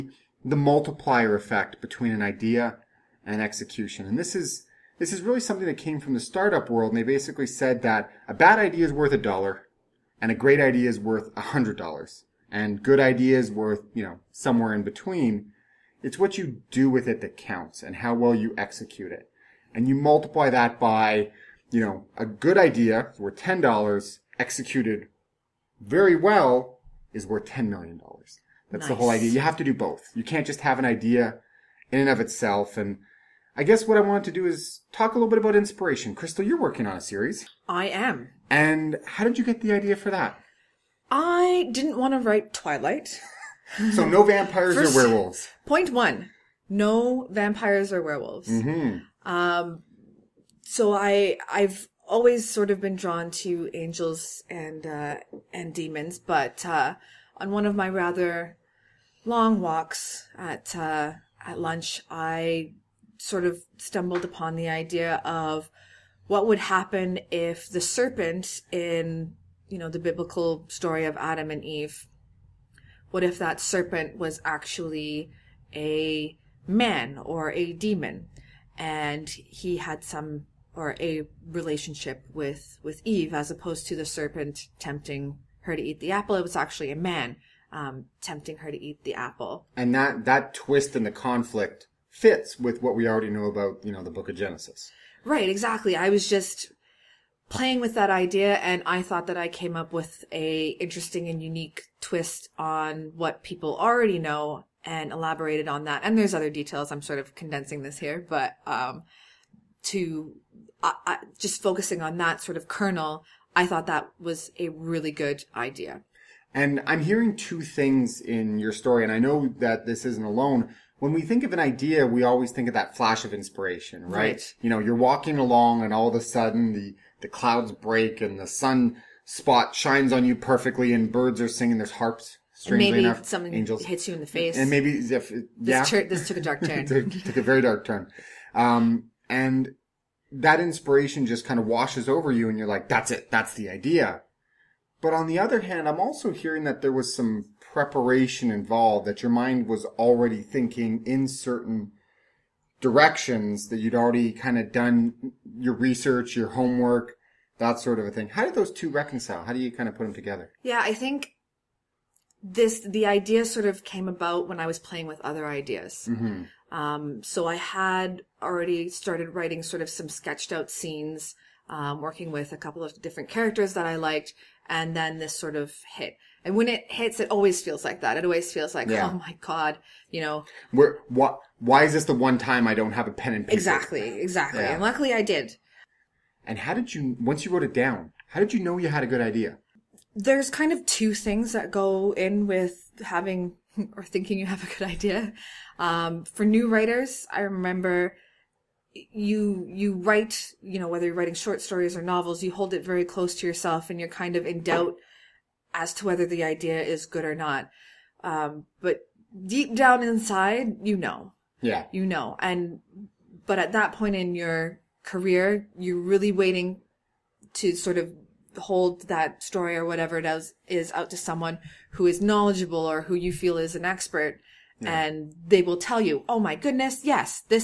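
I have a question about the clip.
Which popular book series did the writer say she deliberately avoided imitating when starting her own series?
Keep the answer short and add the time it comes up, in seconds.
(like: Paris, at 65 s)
Twilight, at 42 s.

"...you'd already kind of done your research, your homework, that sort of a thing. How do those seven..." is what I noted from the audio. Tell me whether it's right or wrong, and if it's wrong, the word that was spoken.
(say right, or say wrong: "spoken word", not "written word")
wrong: "two", not "seven".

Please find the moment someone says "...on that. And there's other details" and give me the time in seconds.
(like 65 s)
105 s.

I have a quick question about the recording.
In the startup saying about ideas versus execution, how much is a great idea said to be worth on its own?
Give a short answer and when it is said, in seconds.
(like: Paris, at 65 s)
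$100, at 11 s.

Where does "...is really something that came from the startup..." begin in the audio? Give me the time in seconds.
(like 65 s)
5 s.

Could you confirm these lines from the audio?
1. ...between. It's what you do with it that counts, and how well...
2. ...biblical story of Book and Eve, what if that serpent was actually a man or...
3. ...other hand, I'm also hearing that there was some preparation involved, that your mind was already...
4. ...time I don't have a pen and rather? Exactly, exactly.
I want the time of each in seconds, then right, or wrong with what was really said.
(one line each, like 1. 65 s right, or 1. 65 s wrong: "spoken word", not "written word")
1. 14 s right
2. 69 s wrong: "Adam", not "Book"
3. 145 s right
4. 182 s wrong: "paper", not "rather".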